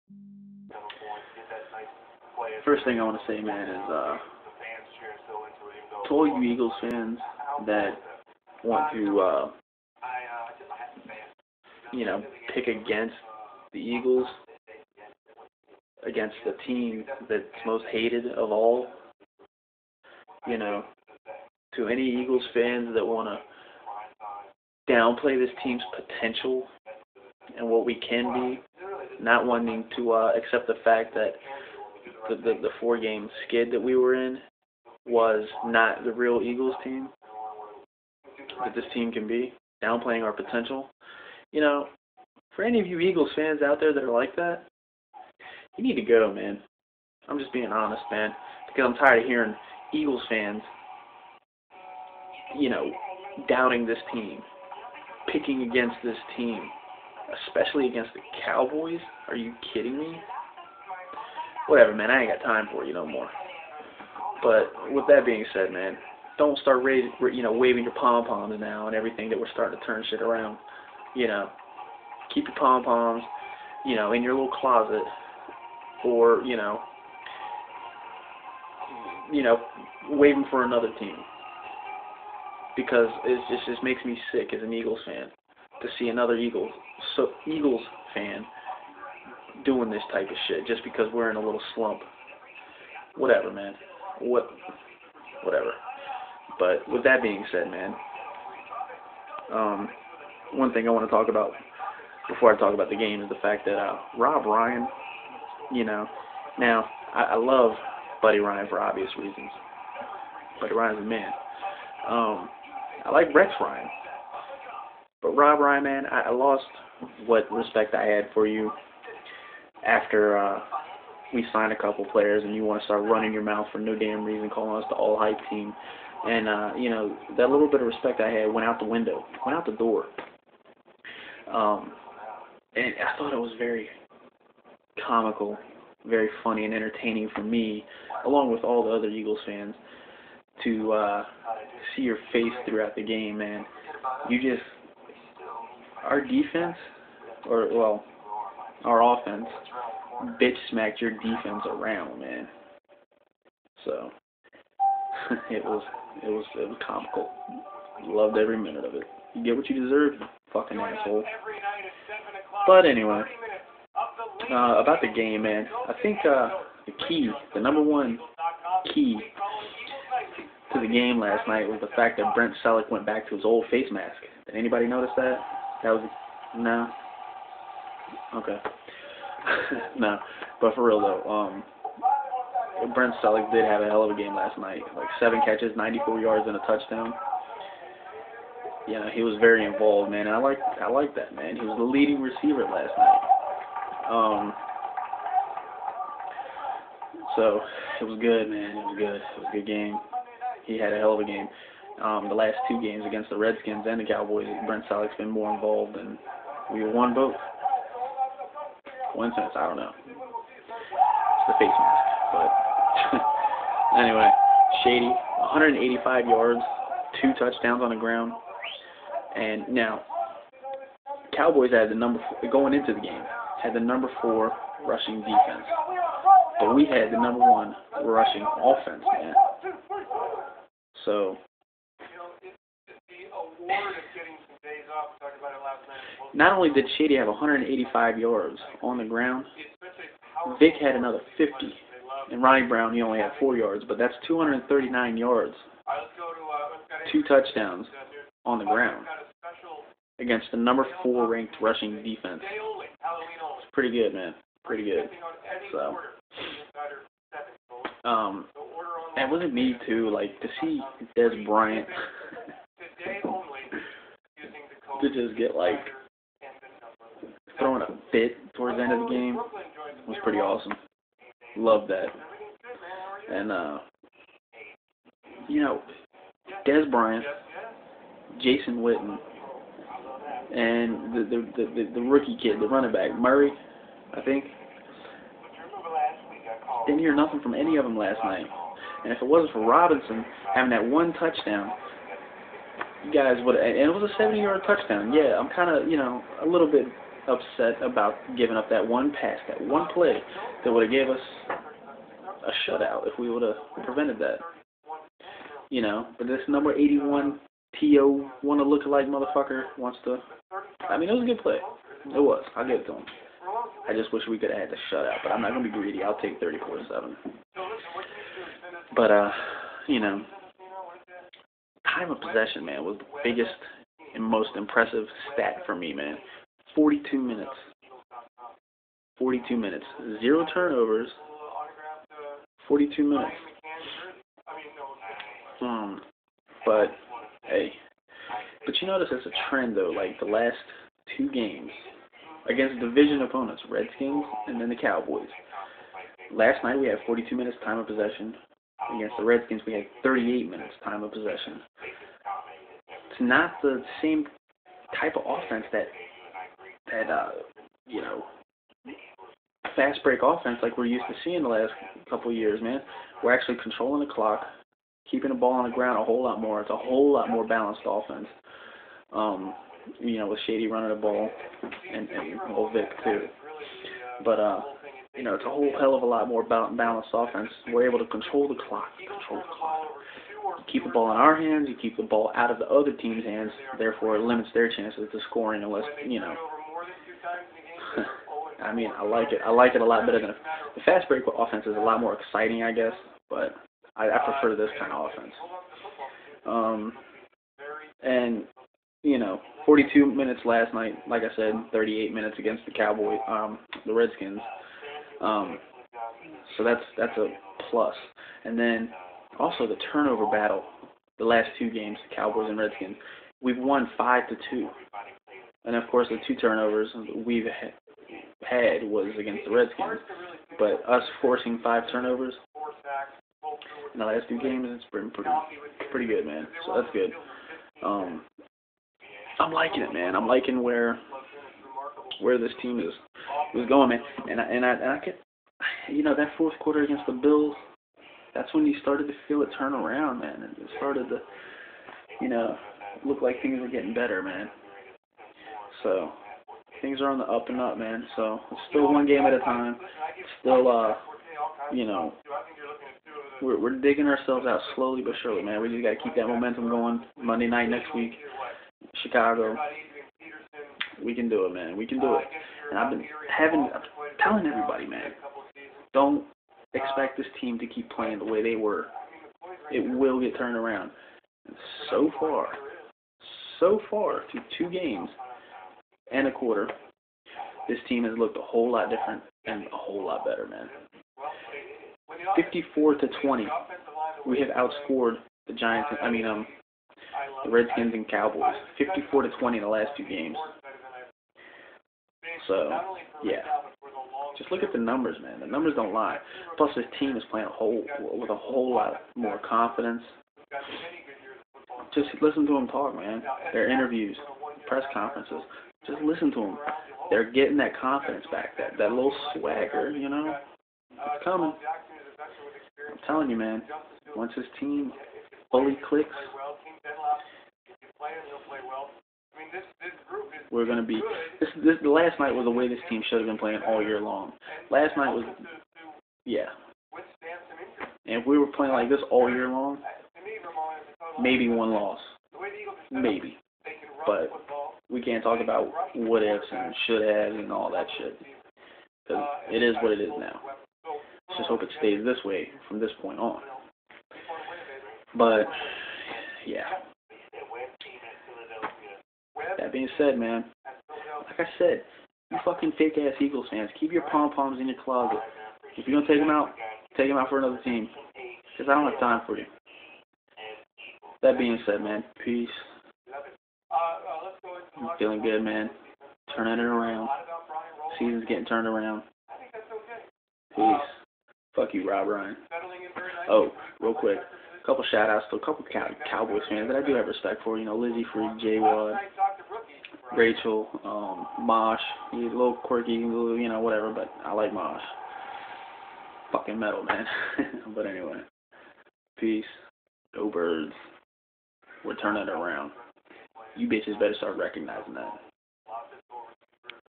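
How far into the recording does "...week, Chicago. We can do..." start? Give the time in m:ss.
7:37.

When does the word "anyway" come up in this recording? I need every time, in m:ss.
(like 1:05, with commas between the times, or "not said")
2:42, 3:33, 9:47.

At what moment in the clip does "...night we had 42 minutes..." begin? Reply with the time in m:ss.
5:46.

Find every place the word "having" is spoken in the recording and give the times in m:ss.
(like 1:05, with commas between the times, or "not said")
4:50, 7:43.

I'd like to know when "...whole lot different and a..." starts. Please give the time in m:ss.
7:58.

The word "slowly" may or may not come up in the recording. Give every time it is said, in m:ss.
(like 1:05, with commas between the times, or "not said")
7:34.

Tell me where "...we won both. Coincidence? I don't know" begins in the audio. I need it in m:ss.
3:26.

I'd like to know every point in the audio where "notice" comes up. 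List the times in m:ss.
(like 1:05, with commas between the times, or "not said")
2:54, 5:38.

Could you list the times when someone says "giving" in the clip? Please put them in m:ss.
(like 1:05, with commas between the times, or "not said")
4:58.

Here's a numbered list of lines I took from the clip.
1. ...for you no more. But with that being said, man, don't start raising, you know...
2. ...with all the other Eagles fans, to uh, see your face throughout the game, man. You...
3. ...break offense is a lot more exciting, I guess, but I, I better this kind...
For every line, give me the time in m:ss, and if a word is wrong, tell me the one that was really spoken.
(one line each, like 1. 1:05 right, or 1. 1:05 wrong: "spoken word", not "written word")
1. 1:02 right
2. 2:18 right
3. 6:31 wrong: "prefer", not "better".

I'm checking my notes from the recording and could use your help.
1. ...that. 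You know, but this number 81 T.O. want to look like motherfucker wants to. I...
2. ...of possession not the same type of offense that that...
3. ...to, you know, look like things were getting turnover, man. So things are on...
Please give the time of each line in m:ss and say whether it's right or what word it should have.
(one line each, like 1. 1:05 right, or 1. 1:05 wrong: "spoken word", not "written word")
1. 5:04 right
2. 5:51 right
3. 7:21 wrong: "better", not "turnover".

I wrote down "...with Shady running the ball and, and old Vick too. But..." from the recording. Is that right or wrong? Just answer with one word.
right.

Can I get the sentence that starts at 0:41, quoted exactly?
You know, for any of you Eagles fans out there that are like that, you need to go, man.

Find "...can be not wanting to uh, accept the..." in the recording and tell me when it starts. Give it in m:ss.
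0:28.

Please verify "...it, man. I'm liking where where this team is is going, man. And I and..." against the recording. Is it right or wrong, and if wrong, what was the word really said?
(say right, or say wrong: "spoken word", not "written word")
right.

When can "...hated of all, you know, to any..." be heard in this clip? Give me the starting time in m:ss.
0:17.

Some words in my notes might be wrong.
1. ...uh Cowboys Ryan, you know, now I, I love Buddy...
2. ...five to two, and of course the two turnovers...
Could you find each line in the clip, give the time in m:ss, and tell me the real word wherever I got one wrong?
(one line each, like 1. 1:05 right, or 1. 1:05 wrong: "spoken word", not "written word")
1. 1:43 wrong: "Rob", not "Cowboys"
2. 6:53 right.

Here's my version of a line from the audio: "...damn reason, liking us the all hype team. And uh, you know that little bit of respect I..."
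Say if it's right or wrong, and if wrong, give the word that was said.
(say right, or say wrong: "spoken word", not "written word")
wrong: "calling", not "liking".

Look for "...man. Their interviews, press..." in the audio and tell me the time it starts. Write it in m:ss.
8:22.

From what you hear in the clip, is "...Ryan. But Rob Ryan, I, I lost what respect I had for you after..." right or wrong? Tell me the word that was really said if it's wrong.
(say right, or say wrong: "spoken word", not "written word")
right.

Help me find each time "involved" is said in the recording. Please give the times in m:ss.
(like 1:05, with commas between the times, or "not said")
3:09, 3:25.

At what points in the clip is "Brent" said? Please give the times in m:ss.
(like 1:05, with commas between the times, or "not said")
2:52, 3:02, 3:24.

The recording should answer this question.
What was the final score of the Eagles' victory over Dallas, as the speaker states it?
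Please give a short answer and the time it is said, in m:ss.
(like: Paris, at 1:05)
34 to 7, at 5:16.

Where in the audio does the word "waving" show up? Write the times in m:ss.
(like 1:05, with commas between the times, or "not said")
1:07, 1:20.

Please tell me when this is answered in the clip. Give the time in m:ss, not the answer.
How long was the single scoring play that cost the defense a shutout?
4:54.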